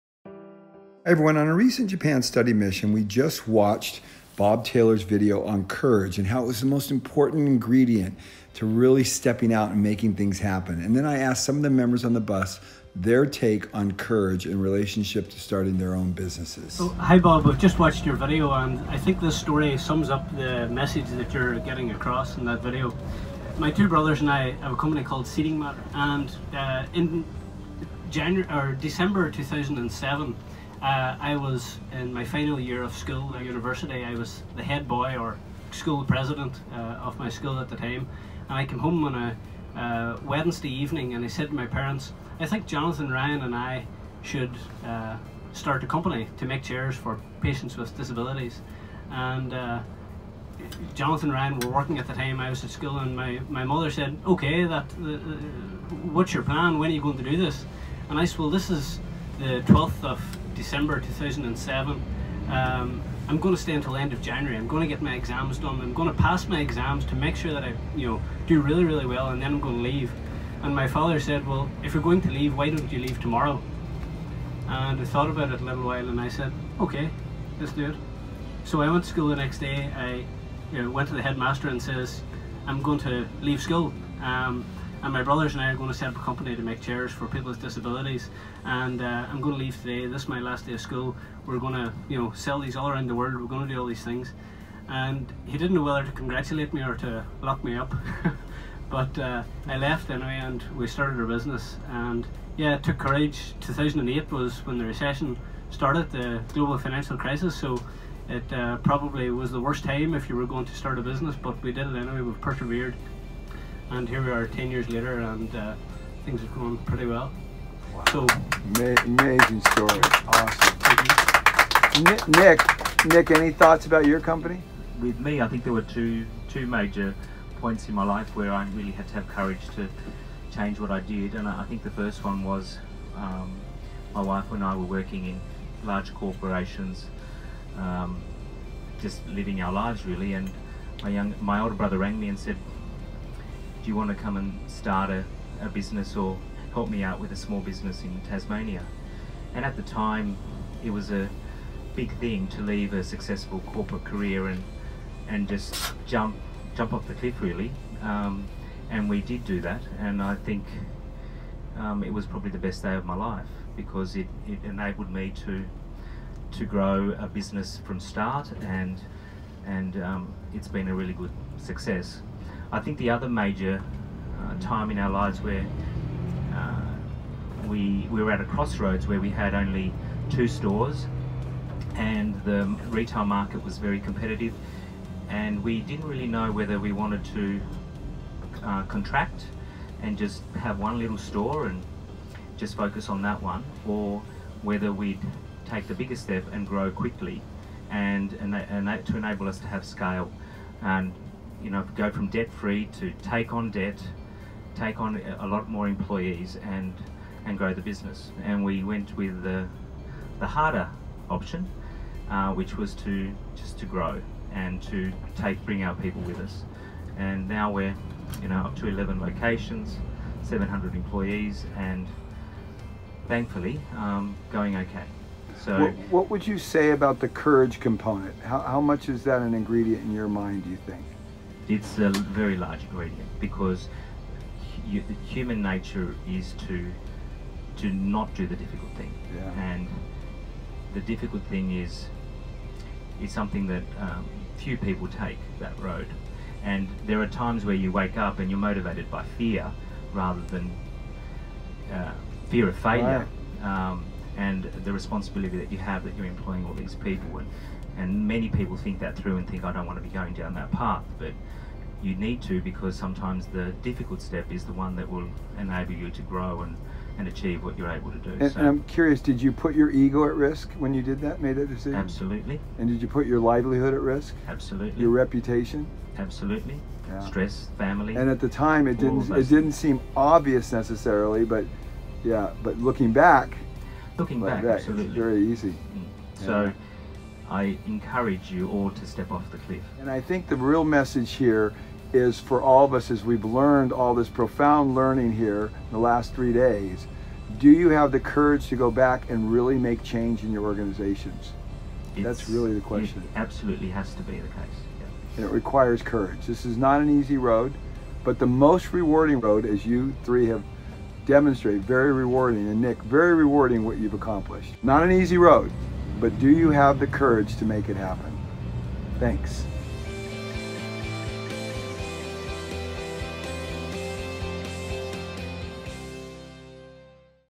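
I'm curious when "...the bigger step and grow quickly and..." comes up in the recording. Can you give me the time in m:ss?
3:15.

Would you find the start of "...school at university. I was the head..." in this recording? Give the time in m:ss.
0:32.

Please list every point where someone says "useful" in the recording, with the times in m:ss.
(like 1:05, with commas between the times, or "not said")
not said.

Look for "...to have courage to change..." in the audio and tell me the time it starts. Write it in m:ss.
2:09.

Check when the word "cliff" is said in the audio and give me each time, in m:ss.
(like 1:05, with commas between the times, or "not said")
2:37, 4:49.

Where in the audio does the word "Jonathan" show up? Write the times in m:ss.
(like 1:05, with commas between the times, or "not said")
0:42, 0:50.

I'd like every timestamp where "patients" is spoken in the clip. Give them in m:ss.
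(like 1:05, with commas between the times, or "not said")
0:47.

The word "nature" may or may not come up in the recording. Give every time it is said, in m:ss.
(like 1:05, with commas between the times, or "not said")
3:55.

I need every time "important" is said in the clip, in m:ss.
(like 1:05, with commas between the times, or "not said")
0:06.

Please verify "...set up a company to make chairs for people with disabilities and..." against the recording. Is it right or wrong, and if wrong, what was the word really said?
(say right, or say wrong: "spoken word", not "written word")
right.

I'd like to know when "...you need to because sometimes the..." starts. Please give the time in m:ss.
4:22.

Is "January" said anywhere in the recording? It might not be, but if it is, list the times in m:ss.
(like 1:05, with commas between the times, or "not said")
0:28, 1:04.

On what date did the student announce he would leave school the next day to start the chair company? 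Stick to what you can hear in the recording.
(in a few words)
12th of December 2007.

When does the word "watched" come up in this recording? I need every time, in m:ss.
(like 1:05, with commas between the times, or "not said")
0:03, 0:17.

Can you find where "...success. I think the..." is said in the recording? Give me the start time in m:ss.
2:51.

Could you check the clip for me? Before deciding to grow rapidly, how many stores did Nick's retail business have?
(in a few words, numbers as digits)
2.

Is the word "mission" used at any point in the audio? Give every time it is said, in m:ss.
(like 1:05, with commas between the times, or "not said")
0:02.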